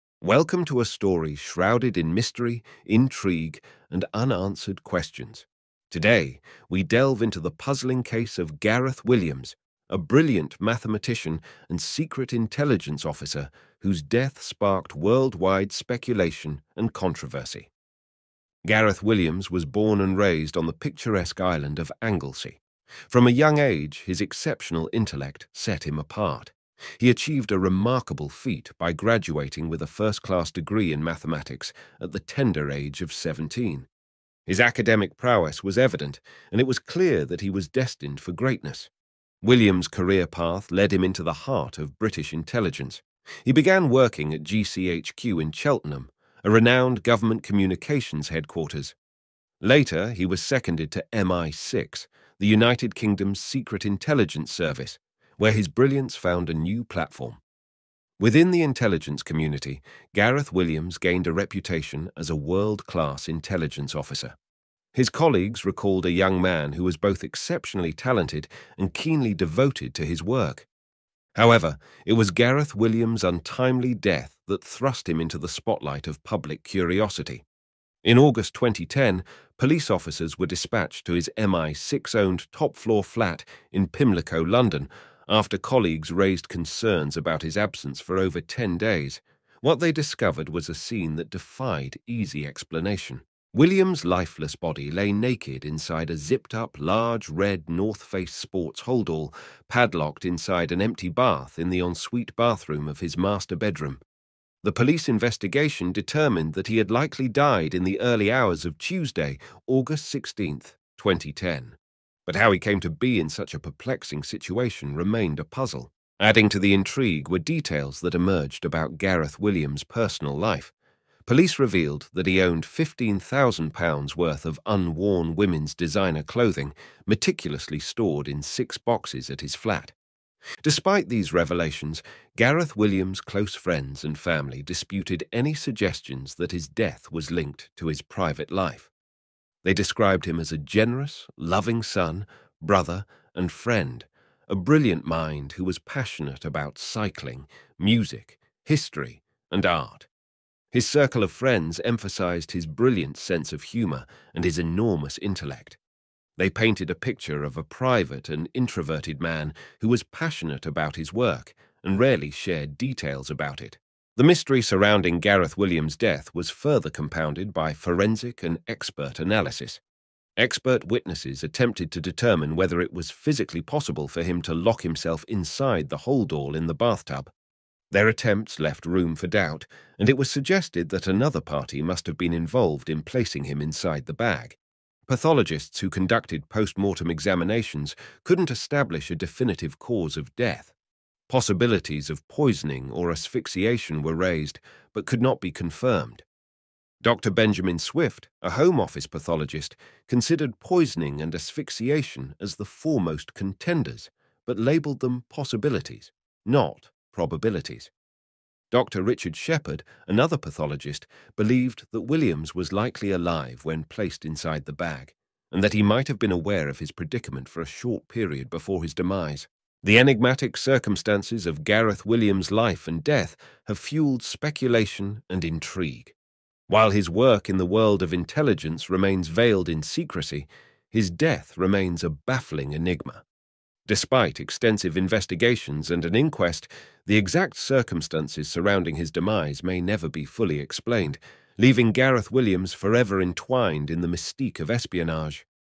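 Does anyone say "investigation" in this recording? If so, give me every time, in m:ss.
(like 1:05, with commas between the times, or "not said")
1:45, 3:54.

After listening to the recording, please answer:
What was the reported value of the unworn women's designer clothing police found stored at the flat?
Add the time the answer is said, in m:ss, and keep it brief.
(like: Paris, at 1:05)
£15,000, at 2:02.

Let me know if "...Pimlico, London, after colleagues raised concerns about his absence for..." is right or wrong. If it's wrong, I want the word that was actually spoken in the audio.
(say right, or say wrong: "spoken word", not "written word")
right.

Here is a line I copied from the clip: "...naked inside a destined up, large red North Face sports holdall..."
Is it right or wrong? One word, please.
wrong.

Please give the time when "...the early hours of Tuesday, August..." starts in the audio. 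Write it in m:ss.
1:47.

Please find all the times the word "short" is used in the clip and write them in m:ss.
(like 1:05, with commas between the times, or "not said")
3:37.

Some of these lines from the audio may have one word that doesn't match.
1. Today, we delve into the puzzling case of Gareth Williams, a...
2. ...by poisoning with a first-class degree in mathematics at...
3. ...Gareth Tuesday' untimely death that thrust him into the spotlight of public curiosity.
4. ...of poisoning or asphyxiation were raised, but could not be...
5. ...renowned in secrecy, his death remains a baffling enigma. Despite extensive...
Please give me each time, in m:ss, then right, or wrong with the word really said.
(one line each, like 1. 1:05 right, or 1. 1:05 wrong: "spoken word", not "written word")
1. 0:05 right
2. 0:28 wrong: "graduating", not "poisoning"
3. 1:12 wrong: "Williams", not "Tuesday"
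4. 3:12 right
5. 3:49 wrong: "veiled", not "renowned".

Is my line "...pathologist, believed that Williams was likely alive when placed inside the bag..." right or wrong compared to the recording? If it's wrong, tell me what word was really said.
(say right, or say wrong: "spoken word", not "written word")
right.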